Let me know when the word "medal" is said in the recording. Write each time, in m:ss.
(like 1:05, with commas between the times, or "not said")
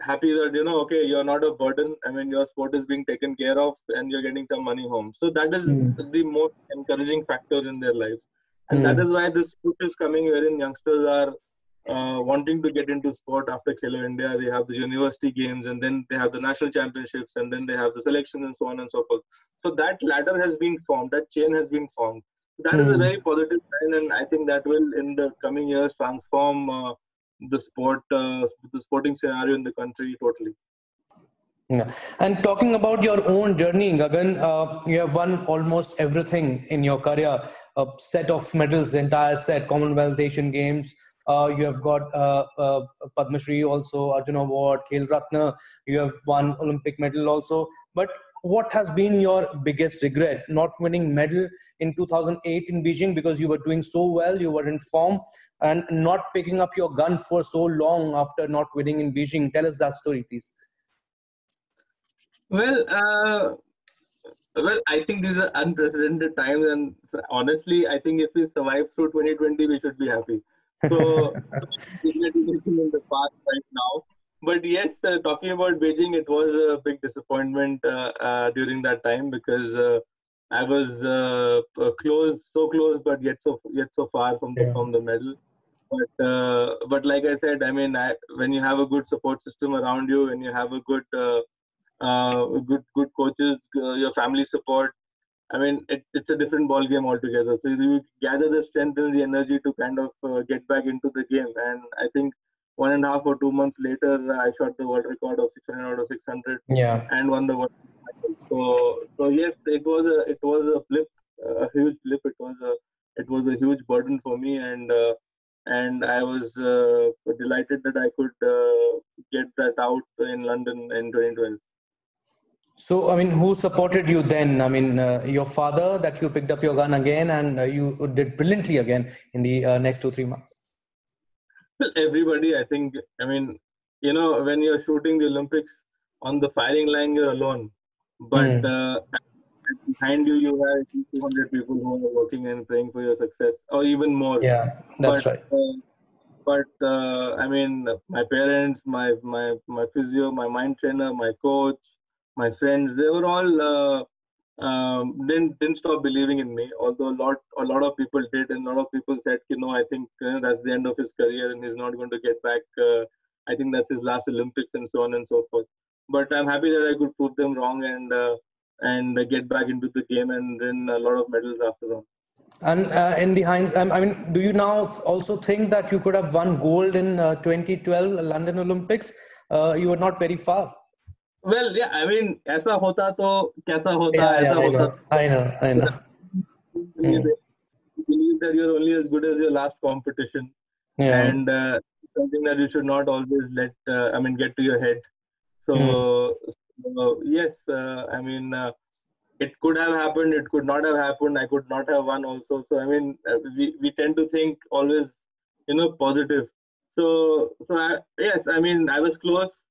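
0:38, 0:46, 0:51, 1:25, 2:51.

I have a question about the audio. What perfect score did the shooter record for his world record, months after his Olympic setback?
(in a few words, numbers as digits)
600 out of 600.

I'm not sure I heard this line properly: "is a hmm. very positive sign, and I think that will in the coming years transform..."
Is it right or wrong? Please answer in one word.
right.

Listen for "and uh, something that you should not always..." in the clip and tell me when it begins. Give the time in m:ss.
3:11.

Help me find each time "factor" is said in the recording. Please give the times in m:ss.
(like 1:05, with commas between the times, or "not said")
0:07.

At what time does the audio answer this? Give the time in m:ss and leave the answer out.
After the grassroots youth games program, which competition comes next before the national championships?
0:14.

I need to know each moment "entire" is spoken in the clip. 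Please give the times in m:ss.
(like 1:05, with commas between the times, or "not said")
0:38.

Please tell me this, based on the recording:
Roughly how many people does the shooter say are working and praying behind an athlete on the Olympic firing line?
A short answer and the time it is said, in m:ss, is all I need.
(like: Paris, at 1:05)
200, at 2:21.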